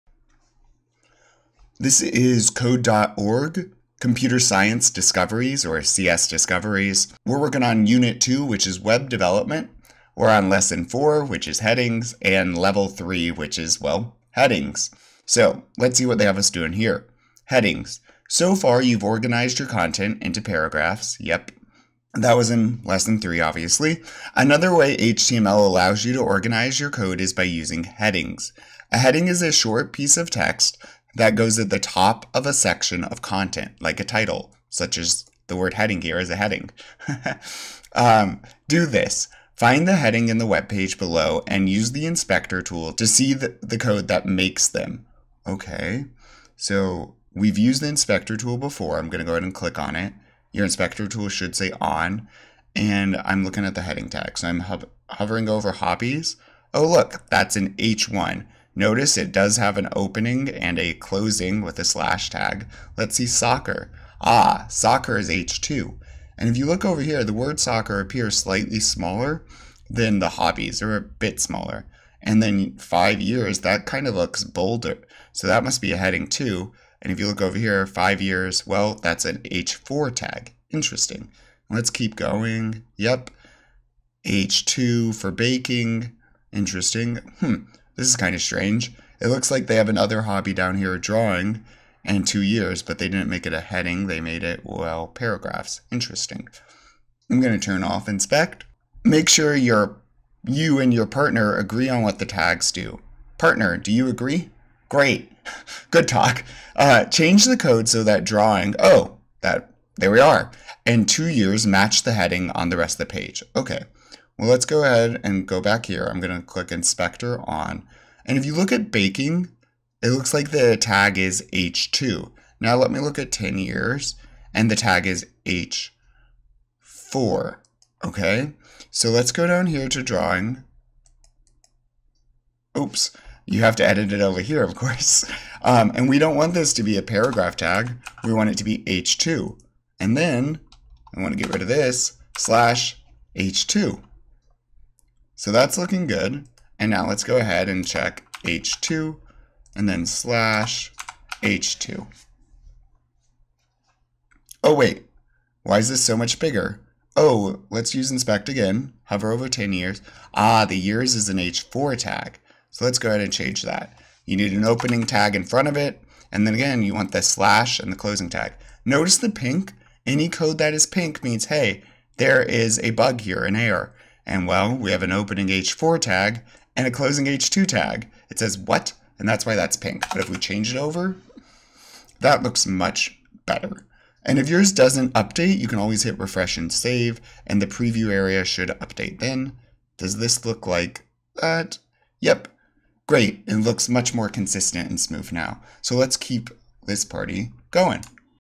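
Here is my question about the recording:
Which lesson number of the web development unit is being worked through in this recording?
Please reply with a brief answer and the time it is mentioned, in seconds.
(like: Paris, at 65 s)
4, at 10 s.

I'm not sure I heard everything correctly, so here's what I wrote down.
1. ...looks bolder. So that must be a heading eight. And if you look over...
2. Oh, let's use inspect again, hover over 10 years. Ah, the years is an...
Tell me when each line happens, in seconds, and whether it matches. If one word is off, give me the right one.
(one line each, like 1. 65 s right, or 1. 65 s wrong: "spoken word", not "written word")
1. 74 s wrong: "two", not "eight"
2. 157 s right.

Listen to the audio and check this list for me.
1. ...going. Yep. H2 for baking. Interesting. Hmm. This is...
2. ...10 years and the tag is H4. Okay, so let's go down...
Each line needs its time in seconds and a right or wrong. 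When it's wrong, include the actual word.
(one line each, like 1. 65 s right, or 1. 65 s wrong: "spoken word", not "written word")
1. 82 s right
2. 123 s right.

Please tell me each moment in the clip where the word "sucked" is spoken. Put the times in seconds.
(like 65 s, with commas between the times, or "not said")
not said.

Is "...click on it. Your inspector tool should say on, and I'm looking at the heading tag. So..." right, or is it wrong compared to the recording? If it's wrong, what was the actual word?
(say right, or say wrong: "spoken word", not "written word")
right.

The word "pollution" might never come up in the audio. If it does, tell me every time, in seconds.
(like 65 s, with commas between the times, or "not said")
not said.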